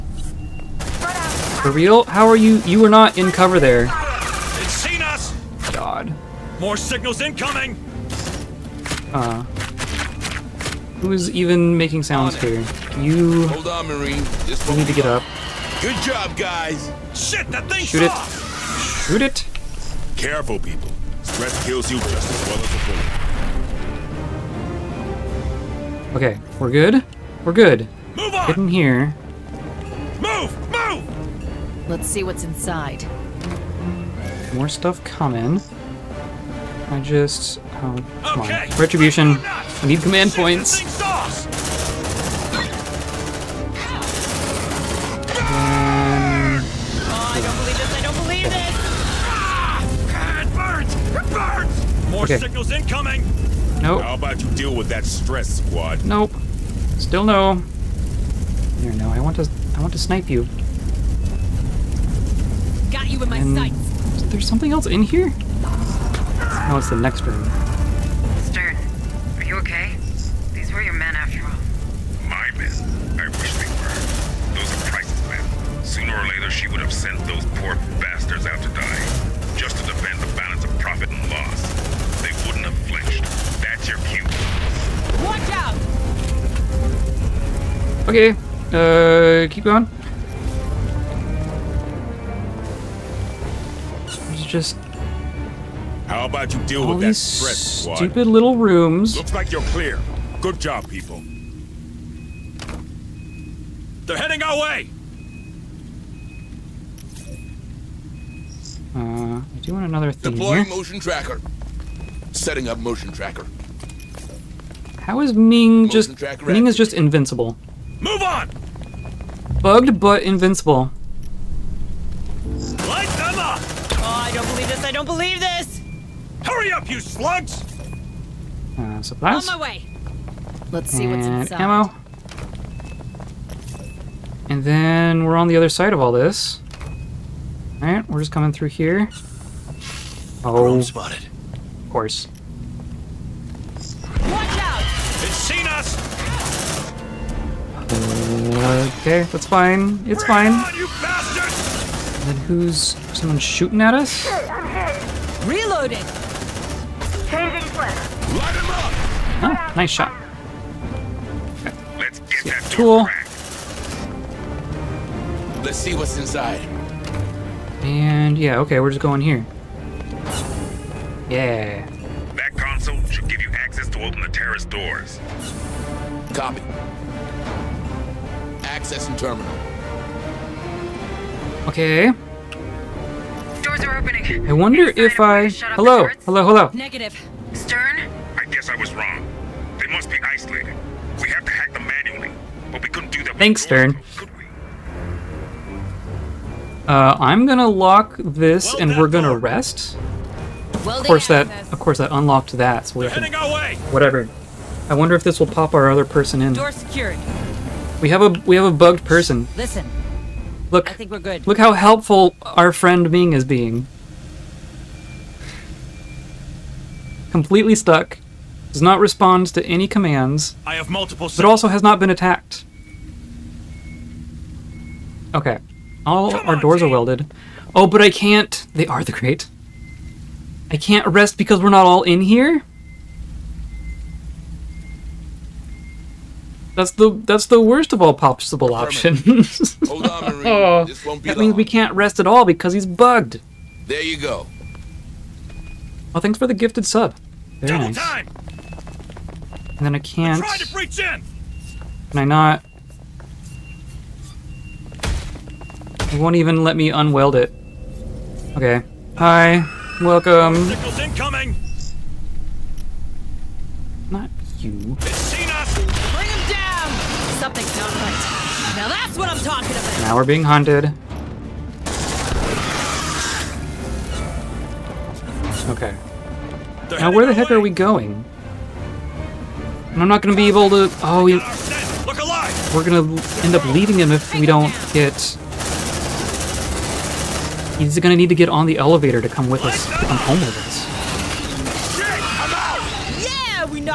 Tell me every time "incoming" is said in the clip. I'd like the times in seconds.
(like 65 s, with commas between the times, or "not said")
7 s, 52 s, 260 s.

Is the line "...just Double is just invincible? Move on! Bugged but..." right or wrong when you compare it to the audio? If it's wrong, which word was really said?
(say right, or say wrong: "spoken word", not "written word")
wrong: "Ming", not "Double".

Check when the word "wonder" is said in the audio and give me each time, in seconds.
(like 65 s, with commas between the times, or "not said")
184 s, 204 s.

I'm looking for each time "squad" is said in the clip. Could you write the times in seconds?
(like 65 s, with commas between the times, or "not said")
55 s, 97 s.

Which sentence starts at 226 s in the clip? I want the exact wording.
All Come our on, doors team.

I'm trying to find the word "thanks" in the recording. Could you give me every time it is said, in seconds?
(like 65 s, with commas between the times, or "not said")
193 s, 246 s.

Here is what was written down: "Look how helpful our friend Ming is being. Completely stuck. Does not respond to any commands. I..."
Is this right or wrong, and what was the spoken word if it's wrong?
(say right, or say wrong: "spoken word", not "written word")
right.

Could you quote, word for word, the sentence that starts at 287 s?
He's gonna need to get on the elevator to come with us, come home with us.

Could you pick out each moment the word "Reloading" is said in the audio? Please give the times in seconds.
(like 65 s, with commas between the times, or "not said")
155 s.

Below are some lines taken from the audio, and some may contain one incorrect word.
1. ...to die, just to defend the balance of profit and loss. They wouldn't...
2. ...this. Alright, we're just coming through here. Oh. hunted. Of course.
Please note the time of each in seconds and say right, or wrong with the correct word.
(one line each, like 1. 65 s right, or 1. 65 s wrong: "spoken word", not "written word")
1. 78 s right
2. 136 s wrong: "spotted", not "hunted".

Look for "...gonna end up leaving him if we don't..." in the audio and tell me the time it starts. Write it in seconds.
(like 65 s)
282 s.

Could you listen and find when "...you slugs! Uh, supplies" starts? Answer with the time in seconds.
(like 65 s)
126 s.